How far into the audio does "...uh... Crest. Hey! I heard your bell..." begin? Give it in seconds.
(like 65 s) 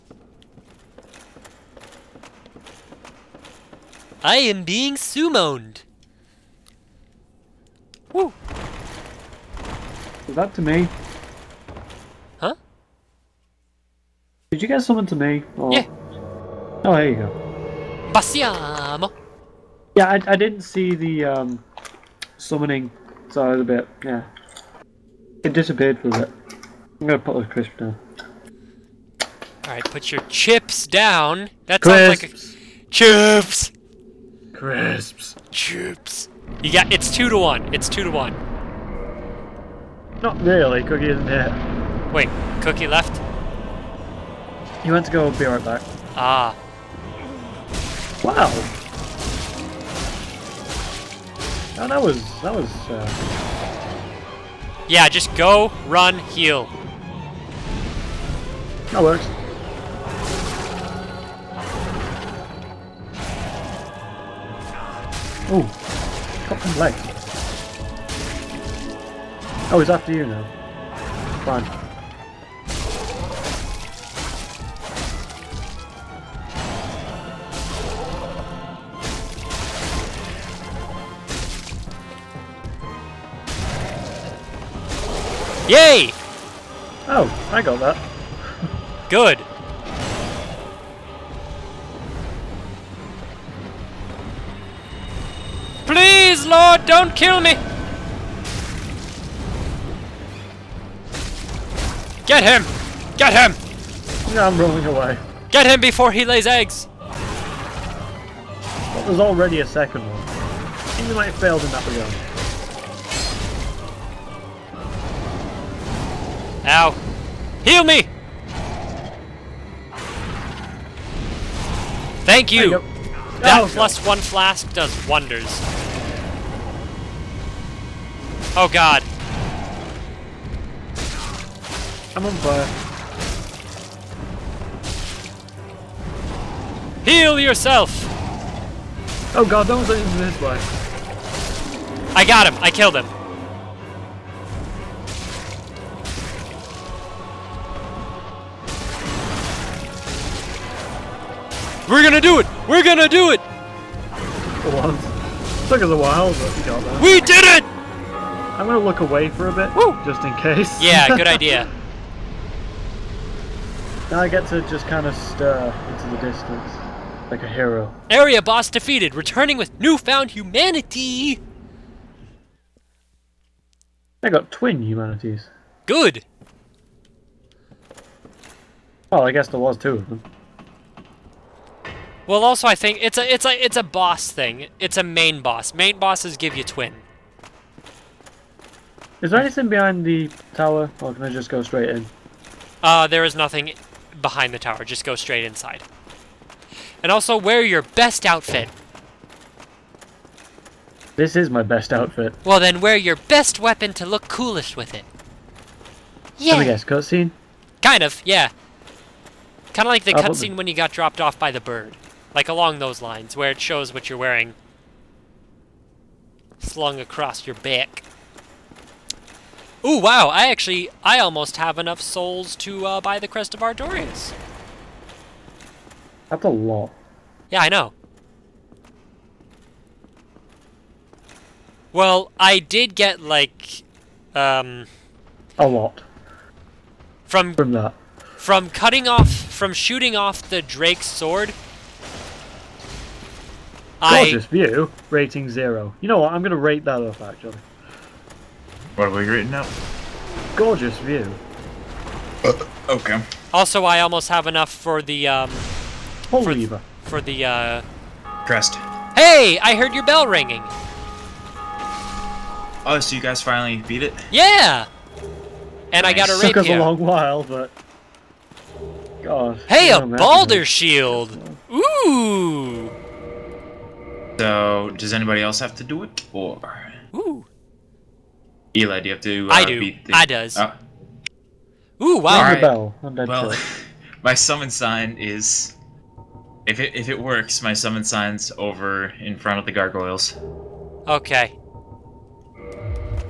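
257 s.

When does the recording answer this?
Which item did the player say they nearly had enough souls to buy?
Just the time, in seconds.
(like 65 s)
223 s.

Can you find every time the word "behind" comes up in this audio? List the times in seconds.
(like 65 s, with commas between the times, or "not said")
189 s, 194 s.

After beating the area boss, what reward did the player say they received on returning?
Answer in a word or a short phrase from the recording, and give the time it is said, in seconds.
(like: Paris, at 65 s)
twin humanities, at 174 s.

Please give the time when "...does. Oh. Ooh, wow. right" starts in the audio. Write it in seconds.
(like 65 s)
280 s.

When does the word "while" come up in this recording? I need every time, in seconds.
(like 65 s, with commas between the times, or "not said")
155 s, 266 s.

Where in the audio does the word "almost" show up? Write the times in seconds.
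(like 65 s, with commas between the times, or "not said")
221 s, 253 s.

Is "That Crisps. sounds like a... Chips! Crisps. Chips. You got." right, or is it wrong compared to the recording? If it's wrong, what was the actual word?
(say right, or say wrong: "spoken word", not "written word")
right.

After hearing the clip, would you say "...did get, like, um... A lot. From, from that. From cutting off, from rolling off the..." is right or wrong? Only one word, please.
wrong.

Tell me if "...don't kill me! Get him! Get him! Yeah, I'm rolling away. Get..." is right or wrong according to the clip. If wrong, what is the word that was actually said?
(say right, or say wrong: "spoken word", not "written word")
right.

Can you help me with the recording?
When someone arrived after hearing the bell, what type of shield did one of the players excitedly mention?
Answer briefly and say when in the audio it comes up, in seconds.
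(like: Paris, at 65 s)
Balder Shield, at 270 s.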